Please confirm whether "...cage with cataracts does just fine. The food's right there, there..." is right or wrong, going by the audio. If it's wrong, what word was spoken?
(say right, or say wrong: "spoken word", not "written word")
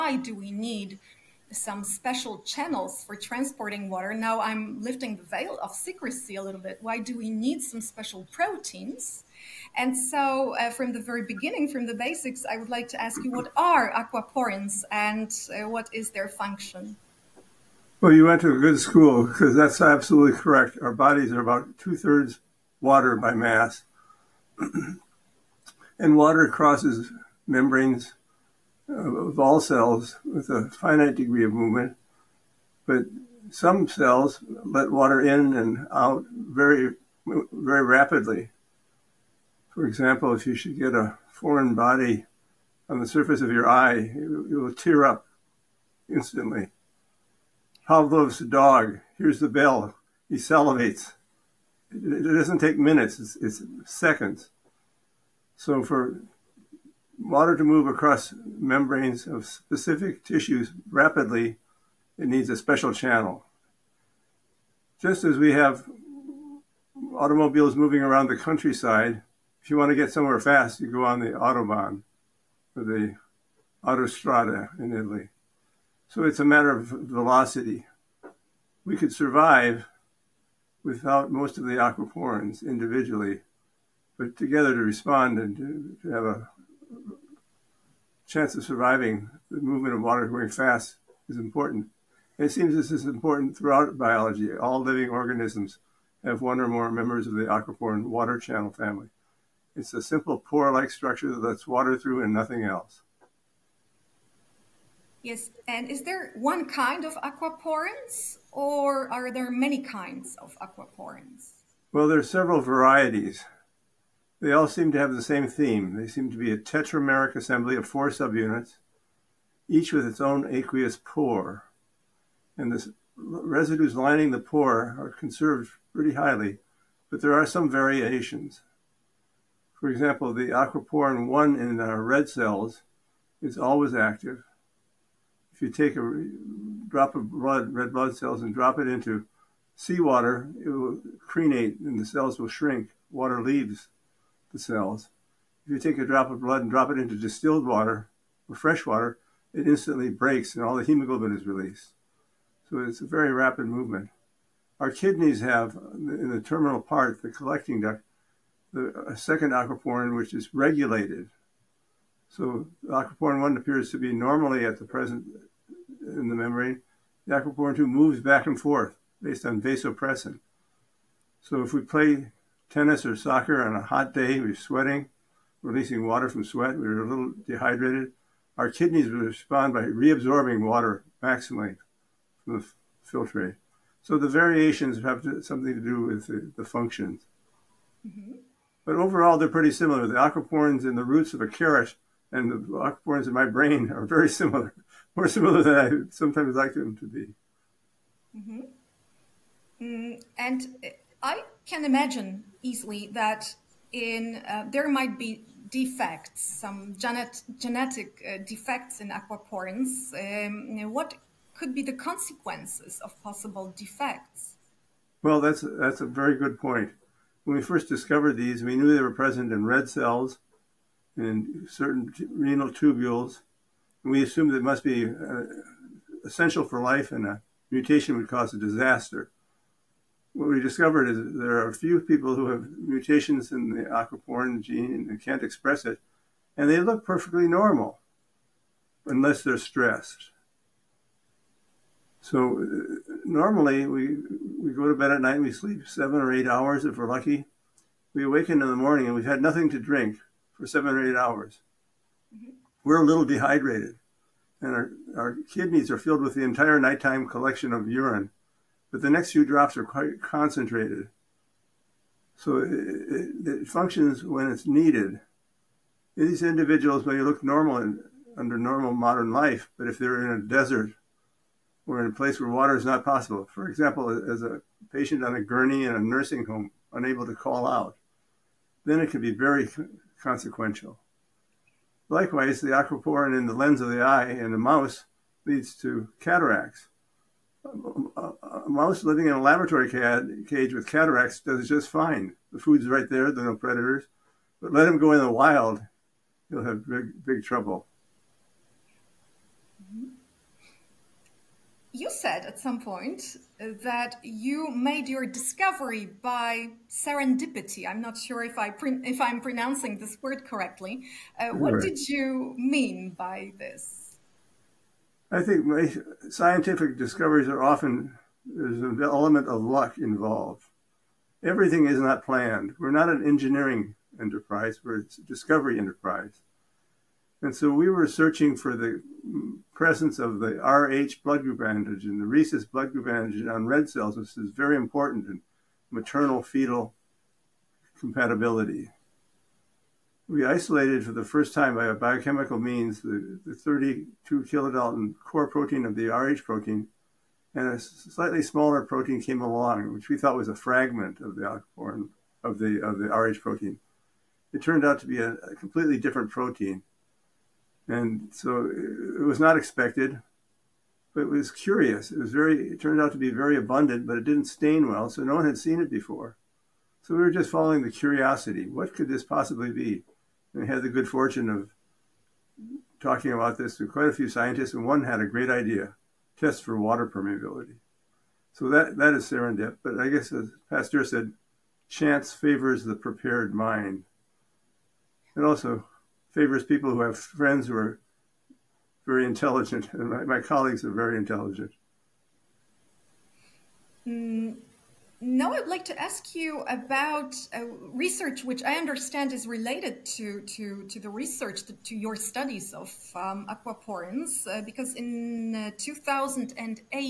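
right.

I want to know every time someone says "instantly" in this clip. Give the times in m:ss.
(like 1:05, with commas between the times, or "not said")
0:46, 2:29.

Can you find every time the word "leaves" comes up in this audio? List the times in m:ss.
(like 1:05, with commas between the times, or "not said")
2:23.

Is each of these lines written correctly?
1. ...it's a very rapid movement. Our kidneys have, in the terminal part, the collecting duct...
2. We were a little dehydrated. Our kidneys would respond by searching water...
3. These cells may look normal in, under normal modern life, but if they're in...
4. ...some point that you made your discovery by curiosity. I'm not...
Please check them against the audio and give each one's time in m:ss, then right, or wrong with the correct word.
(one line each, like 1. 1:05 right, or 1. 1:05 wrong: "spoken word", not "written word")
1. 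2:32 right
2. 2:56 wrong: "reabsorbing", not "searching"
3. 4:26 wrong: "individuals", not "cells"
4. 5:02 wrong: "serendipity", not "curiosity".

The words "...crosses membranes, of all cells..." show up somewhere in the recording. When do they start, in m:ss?
0:26.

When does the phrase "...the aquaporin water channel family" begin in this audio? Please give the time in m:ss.
1:37.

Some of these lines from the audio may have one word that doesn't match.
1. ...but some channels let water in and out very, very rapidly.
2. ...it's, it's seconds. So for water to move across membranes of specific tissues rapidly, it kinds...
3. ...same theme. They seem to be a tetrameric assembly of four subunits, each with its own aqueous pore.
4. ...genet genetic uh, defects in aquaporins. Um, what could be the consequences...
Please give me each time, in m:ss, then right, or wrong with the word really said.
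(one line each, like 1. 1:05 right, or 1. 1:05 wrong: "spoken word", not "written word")
1. 0:32 wrong: "cells", not "channels"
2. 0:53 wrong: "needs", not "kinds"
3. 1:55 right
4. 3:26 right.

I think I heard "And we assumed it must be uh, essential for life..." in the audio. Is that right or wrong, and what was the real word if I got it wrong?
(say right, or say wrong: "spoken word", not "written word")
right.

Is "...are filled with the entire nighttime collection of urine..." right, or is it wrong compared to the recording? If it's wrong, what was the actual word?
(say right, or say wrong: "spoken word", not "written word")
right.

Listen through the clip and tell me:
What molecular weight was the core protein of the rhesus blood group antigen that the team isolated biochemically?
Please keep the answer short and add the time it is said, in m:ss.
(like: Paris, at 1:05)
32 kilodaltons, at 5:43.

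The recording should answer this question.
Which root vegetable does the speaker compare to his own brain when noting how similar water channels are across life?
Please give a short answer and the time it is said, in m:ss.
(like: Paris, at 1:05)
carrot, at 3:11.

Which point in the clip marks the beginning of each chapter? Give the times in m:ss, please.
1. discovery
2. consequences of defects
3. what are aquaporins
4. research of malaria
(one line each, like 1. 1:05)
1. 5:01
2. 3:20
3. 0:12
4. 6:33.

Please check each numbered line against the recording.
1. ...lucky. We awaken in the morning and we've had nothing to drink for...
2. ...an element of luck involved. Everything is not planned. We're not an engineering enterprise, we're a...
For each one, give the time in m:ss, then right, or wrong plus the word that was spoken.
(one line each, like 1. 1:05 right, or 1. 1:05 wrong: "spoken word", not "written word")
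1. 4:07 right
2. 5:18 right.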